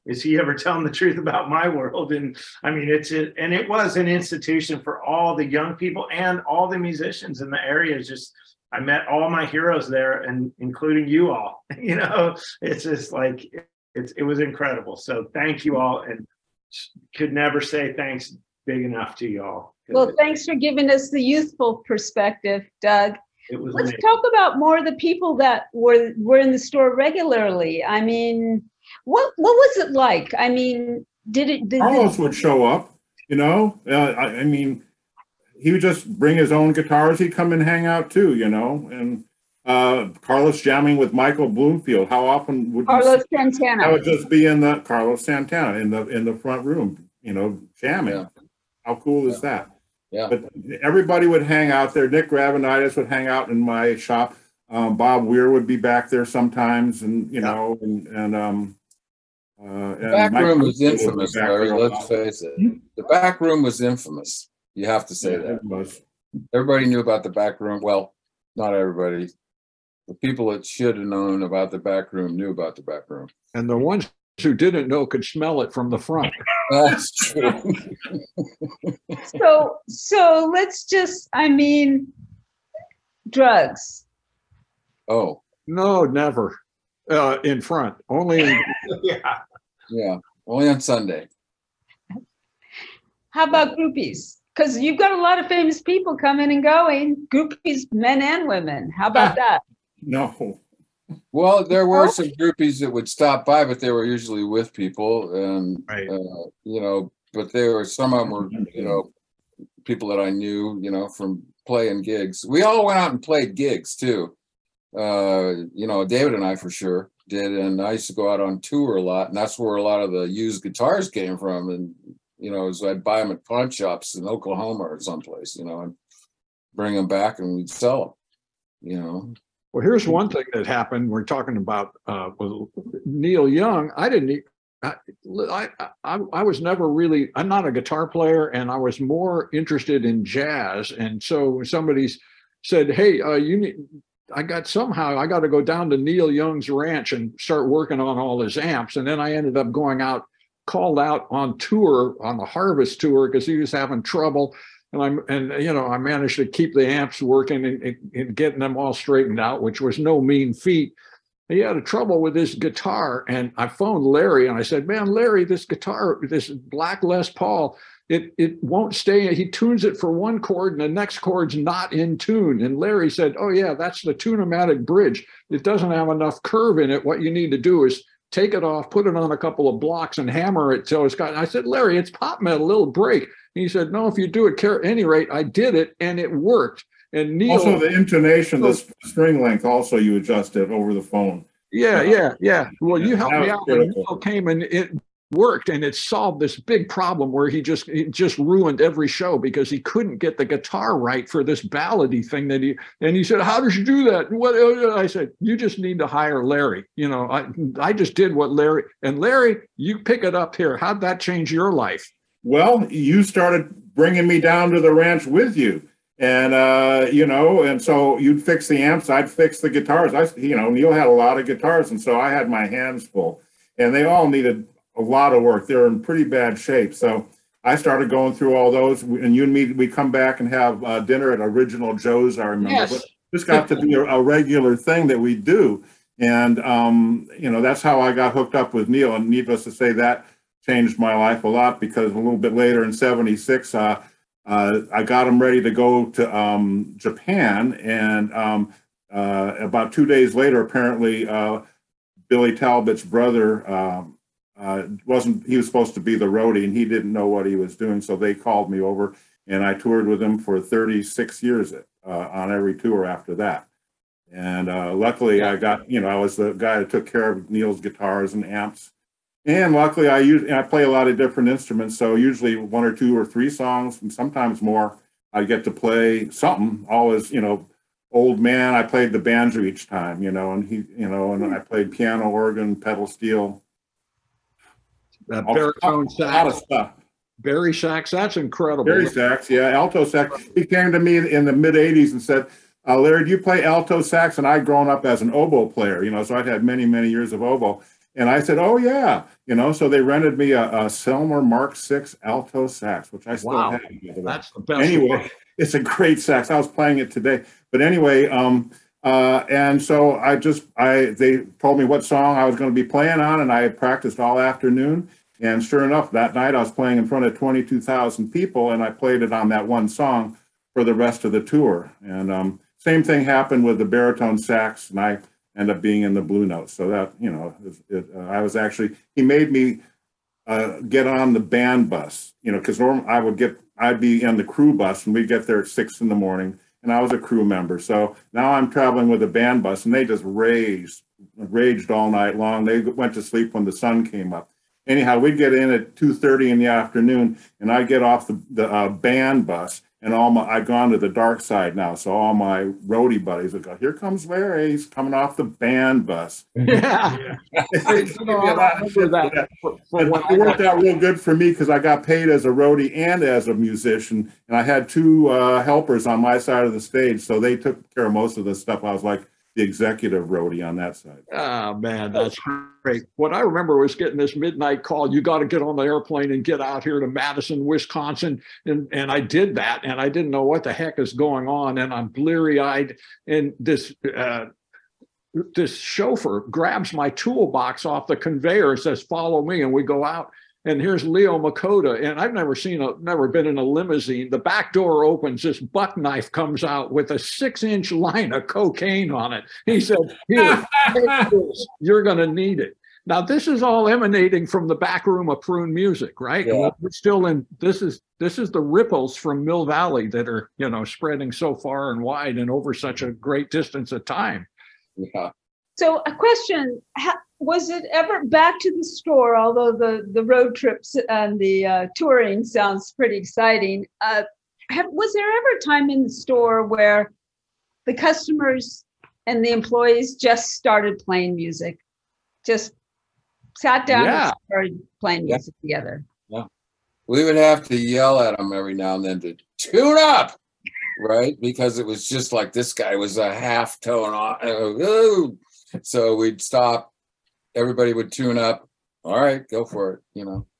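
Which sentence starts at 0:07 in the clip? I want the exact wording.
It's just I met all my heroes there, and including you all.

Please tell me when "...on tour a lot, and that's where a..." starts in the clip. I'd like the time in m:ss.
1:58.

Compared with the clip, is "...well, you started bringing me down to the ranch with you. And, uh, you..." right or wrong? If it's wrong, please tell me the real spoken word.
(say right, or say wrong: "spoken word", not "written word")
right.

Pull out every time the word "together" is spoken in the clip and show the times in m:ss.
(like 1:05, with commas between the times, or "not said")
7:15.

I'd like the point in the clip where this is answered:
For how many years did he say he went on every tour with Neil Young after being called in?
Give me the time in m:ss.
4:20.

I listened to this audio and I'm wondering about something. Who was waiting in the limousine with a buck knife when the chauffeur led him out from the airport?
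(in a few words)
Leo Makota.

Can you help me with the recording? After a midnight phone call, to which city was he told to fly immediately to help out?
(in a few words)
Madison, Wisconsin.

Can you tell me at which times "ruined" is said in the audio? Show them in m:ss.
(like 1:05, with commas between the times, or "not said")
3:18.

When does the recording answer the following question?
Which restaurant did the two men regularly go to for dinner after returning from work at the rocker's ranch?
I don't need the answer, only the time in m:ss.
3:51.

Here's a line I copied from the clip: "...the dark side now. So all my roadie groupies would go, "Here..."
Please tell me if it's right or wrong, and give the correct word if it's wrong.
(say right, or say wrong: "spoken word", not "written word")
wrong: "buddies", not "groupies".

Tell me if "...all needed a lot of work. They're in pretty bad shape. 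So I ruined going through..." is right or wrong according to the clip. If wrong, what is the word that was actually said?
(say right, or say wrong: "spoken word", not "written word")
wrong: "started", not "ruined".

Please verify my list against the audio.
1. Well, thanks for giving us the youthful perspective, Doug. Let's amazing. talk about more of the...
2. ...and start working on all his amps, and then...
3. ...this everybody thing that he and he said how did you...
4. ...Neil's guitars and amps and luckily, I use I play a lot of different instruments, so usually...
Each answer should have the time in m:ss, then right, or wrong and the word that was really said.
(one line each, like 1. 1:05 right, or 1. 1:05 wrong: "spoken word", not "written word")
1. 0:19 right
2. 2:27 right
3. 3:21 wrong: "ballady", not "everybody"
4. 4:27 right.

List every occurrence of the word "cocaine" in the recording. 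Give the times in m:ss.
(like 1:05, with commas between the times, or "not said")
6:38.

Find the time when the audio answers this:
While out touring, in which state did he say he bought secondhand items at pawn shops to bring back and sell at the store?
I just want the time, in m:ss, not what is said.
2:04.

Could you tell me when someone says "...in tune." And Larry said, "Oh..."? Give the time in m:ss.
2:51.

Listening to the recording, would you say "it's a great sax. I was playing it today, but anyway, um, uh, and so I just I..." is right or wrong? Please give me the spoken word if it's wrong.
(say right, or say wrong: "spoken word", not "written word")
right.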